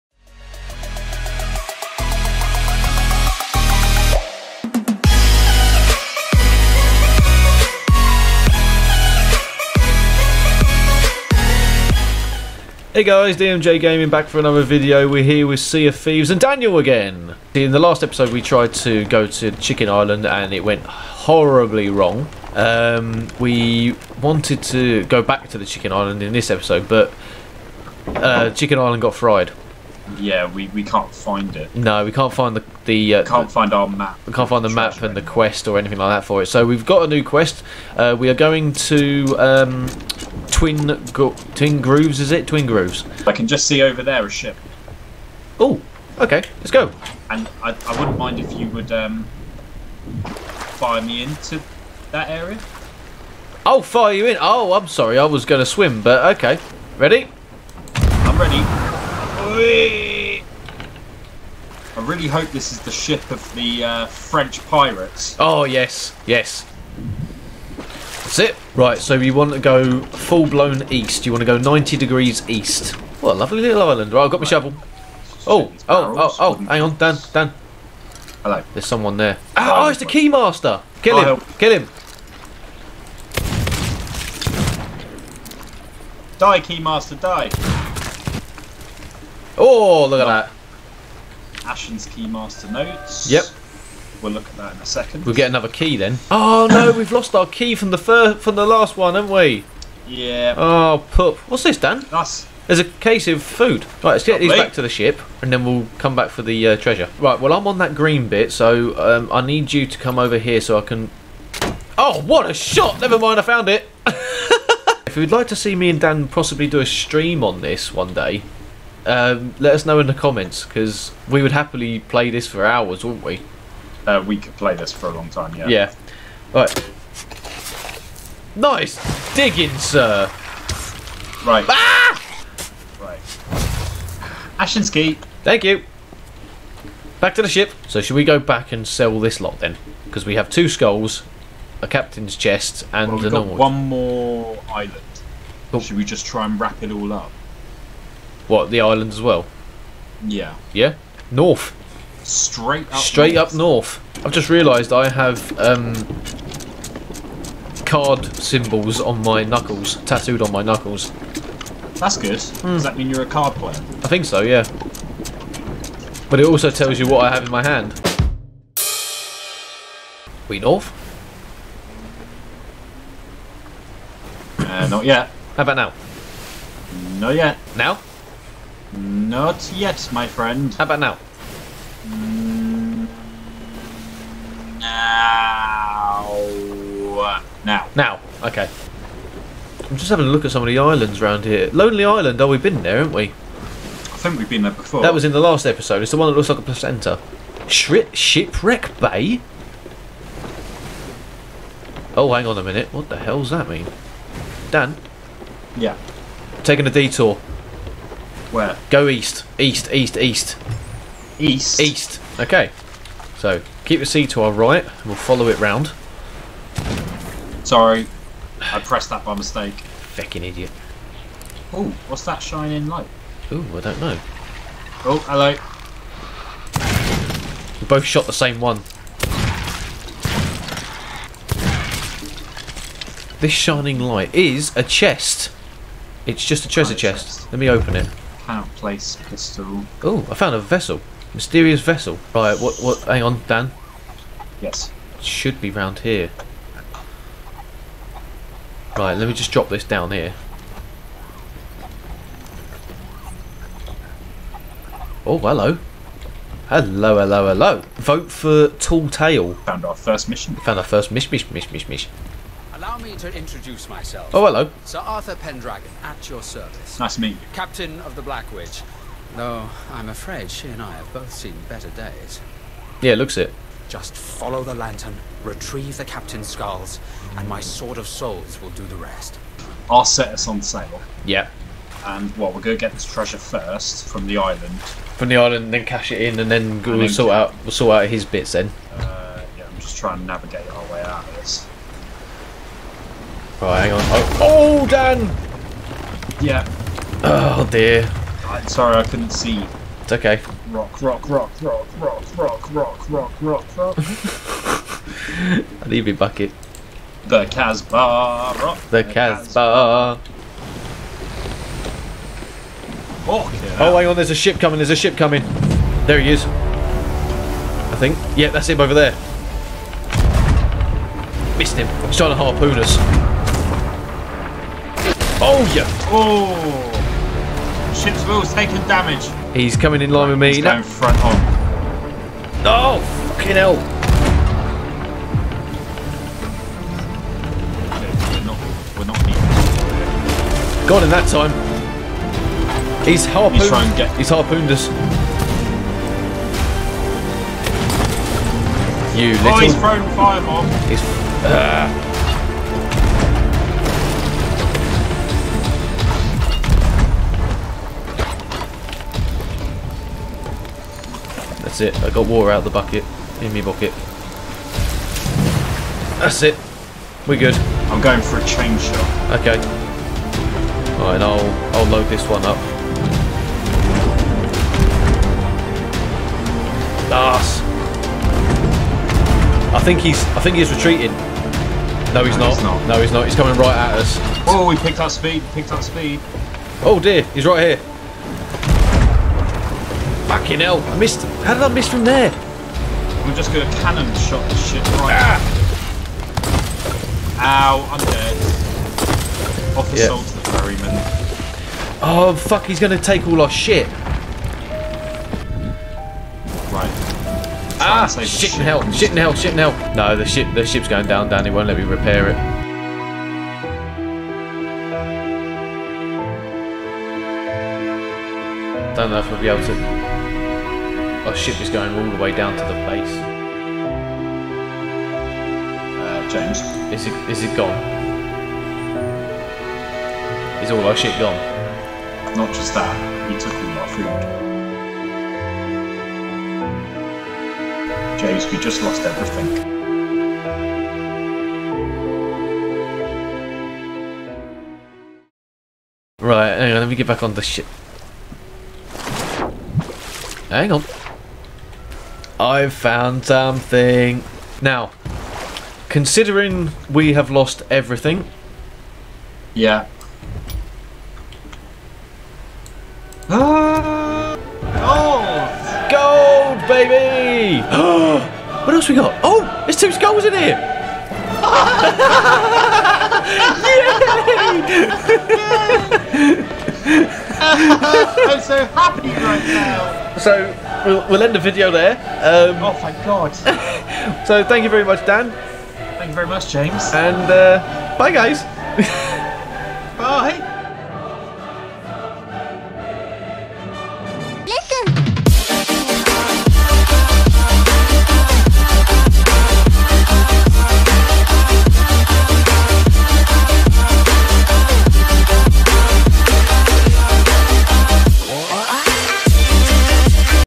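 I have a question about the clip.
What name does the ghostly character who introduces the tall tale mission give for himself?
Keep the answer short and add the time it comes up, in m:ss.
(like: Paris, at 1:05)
Sir Arthur Pendragon, at 4:24.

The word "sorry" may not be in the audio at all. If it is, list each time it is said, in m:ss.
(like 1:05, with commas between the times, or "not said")
0:54, 3:37, 4:58.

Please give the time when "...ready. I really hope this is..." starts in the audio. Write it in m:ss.
0:58.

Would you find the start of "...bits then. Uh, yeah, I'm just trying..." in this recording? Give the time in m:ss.
4:48.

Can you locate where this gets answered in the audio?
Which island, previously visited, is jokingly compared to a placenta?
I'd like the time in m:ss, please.
3:11.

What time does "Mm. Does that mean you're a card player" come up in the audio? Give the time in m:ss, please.
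2:42.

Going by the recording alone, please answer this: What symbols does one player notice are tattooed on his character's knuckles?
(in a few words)
card symbols.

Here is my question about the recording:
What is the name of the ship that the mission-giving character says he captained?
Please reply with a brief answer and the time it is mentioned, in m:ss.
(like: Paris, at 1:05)
Black Witch, at 4:28.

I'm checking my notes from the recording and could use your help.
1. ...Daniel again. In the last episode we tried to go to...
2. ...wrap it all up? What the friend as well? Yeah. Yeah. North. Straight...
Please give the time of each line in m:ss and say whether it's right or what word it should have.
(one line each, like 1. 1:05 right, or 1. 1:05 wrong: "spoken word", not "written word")
1. 0:16 right
2. 2:26 wrong: "island", not "friend".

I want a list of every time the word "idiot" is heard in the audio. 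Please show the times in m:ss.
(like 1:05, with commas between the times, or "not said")
3:40.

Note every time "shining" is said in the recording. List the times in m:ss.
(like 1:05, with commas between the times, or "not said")
3:42, 3:53.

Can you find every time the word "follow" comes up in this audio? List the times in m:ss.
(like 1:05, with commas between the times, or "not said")
3:35, 4:34.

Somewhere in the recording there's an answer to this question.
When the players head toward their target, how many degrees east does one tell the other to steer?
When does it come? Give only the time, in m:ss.
1:11.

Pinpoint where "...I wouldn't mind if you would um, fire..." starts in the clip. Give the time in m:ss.
0:47.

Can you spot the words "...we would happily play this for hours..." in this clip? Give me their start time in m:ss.
2:01.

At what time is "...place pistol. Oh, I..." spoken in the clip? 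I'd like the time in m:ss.
3:58.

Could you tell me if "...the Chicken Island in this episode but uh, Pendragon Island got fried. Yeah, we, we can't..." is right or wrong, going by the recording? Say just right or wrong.
wrong.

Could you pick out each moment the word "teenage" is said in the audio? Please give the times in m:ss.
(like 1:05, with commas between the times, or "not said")
not said.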